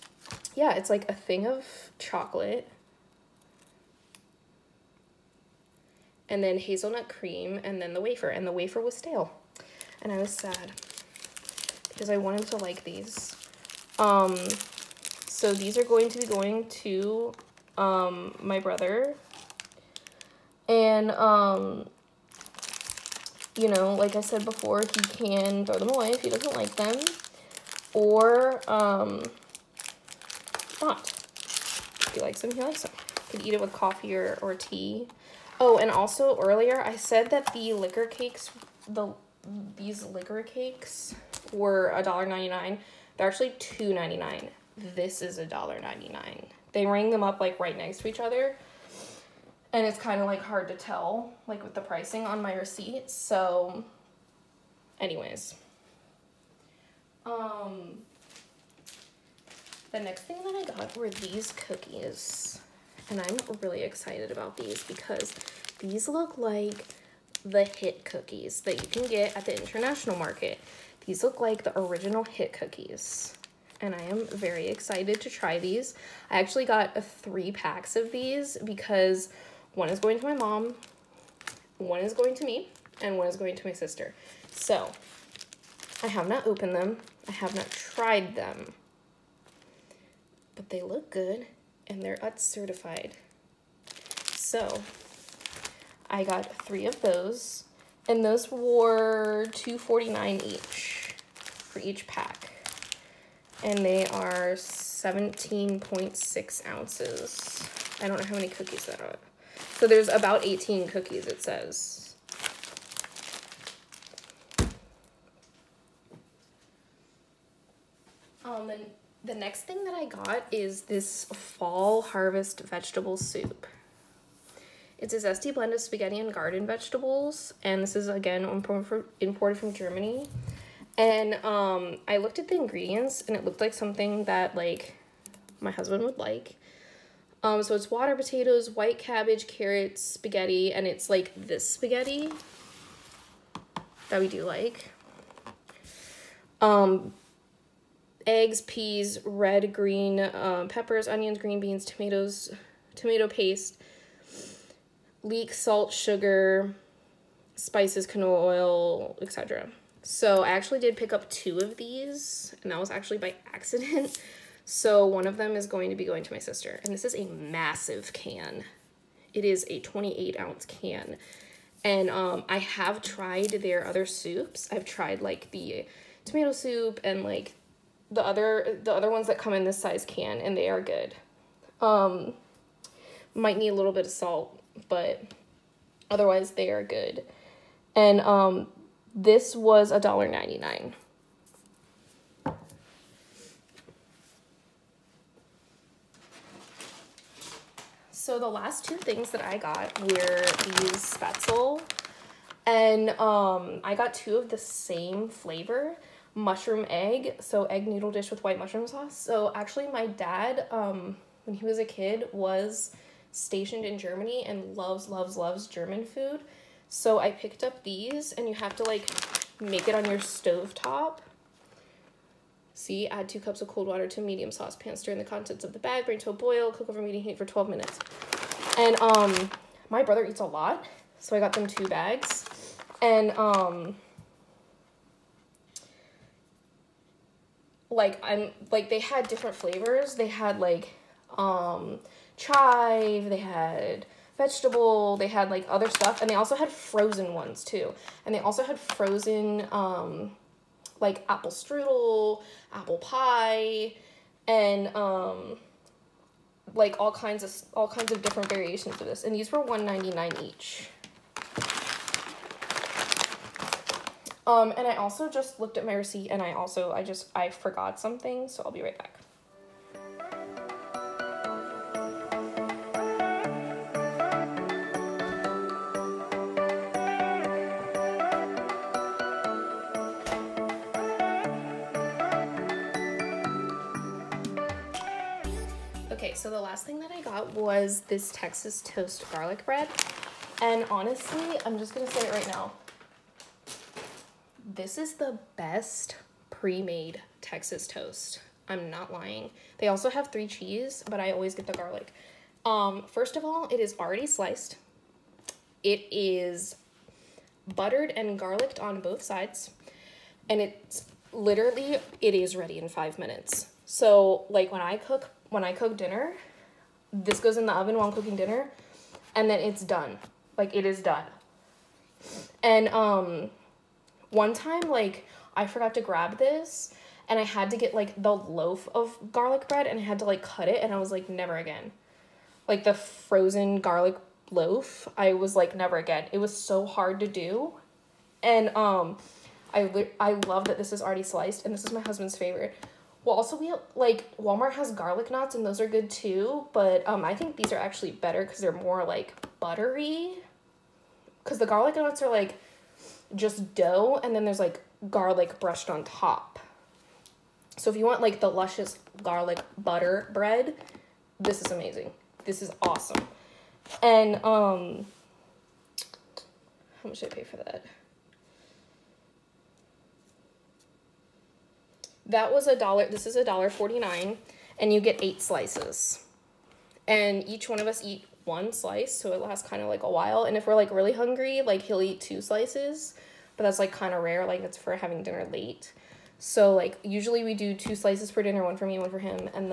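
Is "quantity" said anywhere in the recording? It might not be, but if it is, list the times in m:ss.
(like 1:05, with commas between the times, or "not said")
not said.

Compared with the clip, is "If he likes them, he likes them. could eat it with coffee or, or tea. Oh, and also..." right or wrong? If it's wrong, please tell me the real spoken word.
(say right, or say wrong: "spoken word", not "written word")
right.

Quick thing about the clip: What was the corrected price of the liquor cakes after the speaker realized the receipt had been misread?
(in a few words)
$2.99.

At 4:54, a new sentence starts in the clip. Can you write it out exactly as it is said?
This is the best pre-made Texas toast.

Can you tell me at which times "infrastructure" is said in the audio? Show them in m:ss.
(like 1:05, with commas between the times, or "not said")
not said.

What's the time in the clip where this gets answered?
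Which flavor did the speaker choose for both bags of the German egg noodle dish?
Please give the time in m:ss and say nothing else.
3:26.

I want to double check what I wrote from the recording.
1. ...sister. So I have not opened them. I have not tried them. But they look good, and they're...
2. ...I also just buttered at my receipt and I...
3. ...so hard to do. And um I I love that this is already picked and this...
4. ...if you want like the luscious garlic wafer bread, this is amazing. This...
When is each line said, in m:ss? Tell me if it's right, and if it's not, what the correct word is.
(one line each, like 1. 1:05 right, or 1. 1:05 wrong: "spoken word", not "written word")
1. 1:23 right
2. 4:24 wrong: "looked", not "buttered"
3. 5:36 wrong: "sliced", not "picked"
4. 5:57 wrong: "butter", not "wafer".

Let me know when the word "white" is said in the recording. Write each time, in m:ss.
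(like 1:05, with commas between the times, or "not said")
2:18, 3:28.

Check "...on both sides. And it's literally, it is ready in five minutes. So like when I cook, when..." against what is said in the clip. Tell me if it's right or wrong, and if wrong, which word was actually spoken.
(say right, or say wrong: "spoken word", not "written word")
right.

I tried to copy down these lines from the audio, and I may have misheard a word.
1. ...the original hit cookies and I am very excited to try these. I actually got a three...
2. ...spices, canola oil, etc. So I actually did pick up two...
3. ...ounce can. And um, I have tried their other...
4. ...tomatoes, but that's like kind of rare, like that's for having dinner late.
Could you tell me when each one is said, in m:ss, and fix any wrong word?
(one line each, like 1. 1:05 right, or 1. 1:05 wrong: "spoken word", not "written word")
1. 1:11 right
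2. 2:37 right
3. 2:50 right
4. 6:22 wrong: "slices", not "tomatoes".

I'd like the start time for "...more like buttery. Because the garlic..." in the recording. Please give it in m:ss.
5:48.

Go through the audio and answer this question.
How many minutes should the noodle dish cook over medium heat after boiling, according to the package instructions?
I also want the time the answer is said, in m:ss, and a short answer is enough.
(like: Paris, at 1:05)
12, at 3:47.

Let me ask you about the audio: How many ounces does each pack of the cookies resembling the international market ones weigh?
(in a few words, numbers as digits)
17.6 ounces.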